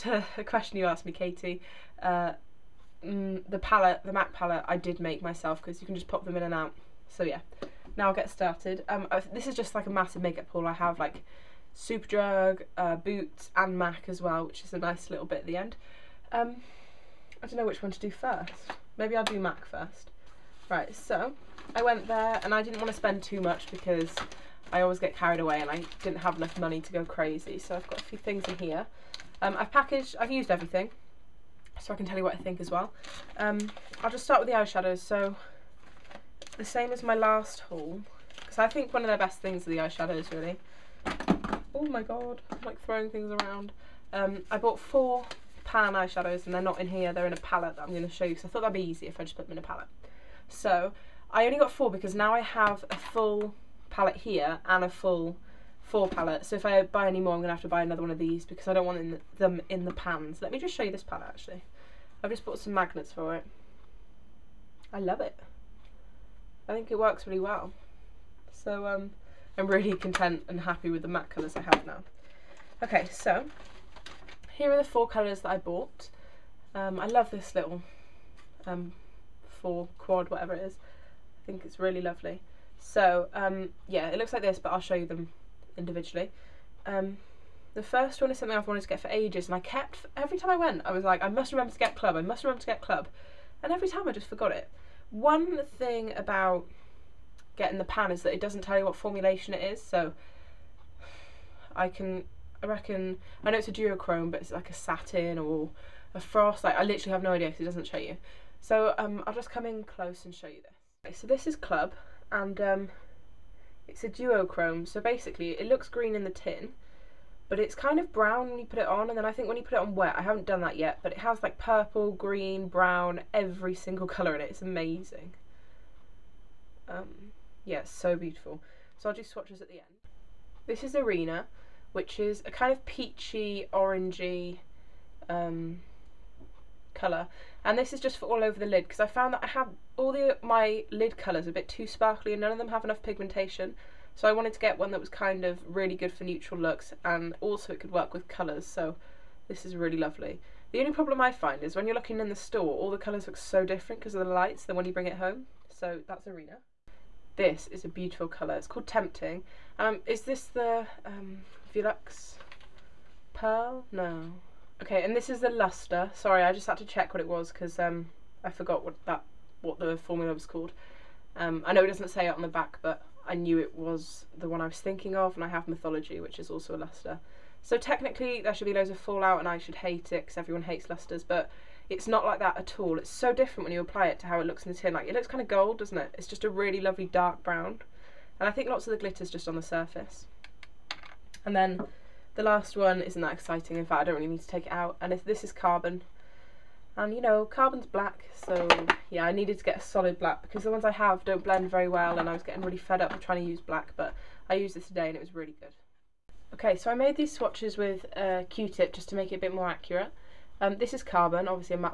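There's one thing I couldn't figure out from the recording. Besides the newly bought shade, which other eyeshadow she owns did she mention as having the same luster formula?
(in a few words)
Mythology.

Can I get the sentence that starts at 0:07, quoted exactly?
So yeah, now I'll get started.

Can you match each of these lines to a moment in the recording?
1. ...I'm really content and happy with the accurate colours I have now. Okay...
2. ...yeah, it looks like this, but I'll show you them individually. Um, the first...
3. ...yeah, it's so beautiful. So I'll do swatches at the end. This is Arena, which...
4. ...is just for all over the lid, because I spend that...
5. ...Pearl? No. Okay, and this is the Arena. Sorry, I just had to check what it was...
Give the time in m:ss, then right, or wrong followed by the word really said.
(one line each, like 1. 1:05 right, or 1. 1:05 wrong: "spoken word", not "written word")
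1. 1:09 wrong: "matte", not "accurate"
2. 1:23 right
3. 2:07 right
4. 2:17 wrong: "found", not "spend"
5. 2:43 wrong: "Luster", not "Arena".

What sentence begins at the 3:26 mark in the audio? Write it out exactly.
Okay so I made these swatches with a uh, q-tip just to make it a bit more accurate.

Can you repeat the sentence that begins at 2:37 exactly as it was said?
This is a beautiful colour, it's called Tempting.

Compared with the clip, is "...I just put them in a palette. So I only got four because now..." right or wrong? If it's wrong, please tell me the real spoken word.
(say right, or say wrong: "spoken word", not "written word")
right.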